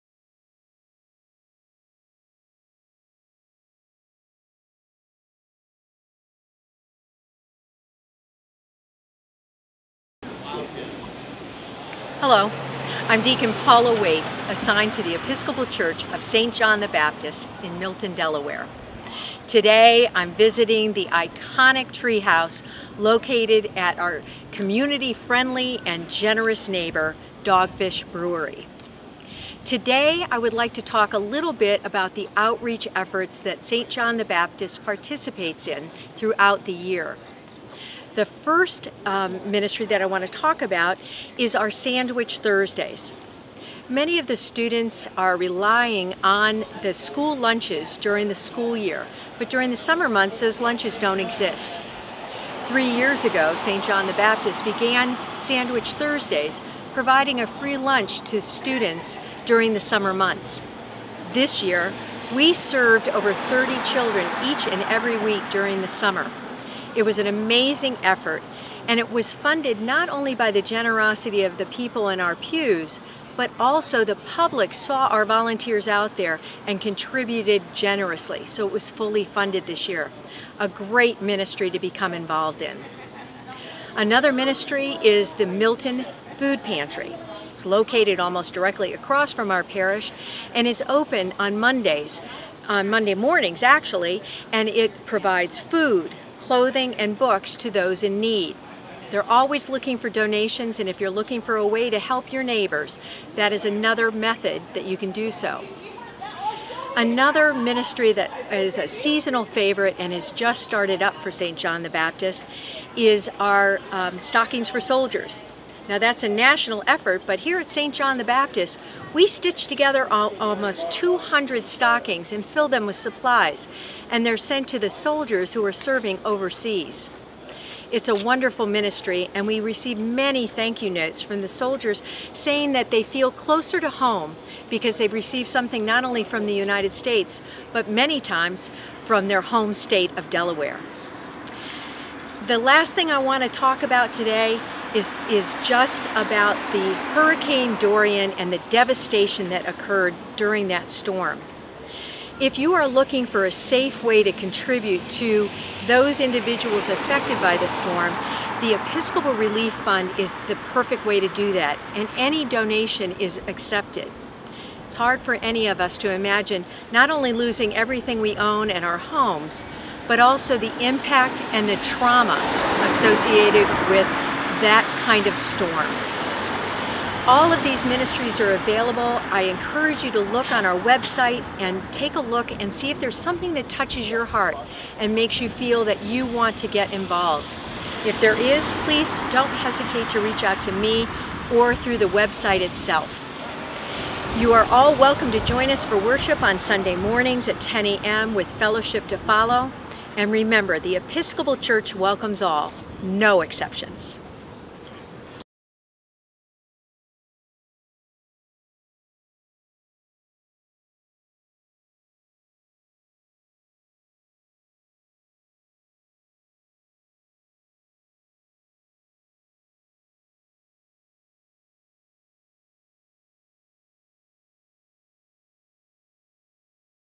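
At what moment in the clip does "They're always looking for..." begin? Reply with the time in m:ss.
1:39.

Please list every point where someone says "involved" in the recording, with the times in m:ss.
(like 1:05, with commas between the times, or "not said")
1:22, 3:06.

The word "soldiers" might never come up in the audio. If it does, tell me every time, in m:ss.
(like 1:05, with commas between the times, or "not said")
1:54, 2:04, 2:11.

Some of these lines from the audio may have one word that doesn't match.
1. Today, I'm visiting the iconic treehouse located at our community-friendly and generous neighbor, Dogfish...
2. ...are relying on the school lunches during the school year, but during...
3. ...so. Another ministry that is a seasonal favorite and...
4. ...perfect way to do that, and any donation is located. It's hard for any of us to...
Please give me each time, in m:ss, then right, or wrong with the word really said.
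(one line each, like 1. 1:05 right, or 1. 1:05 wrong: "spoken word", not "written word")
1. 0:19 right
2. 0:45 right
3. 1:45 right
4. 2:40 wrong: "accepted", not "located".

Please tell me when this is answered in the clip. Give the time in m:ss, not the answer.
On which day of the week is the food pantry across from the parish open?
1:32.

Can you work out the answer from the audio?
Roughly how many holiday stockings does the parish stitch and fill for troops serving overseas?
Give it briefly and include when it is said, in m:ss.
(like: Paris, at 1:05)
almost 200, at 2:00.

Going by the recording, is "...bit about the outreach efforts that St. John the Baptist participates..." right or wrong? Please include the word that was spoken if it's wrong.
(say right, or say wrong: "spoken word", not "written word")
right.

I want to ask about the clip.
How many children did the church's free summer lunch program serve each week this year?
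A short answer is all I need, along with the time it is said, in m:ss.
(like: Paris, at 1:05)
over 30, at 1:03.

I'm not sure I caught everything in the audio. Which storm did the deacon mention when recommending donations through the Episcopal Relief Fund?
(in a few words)
Hurricane Dorian.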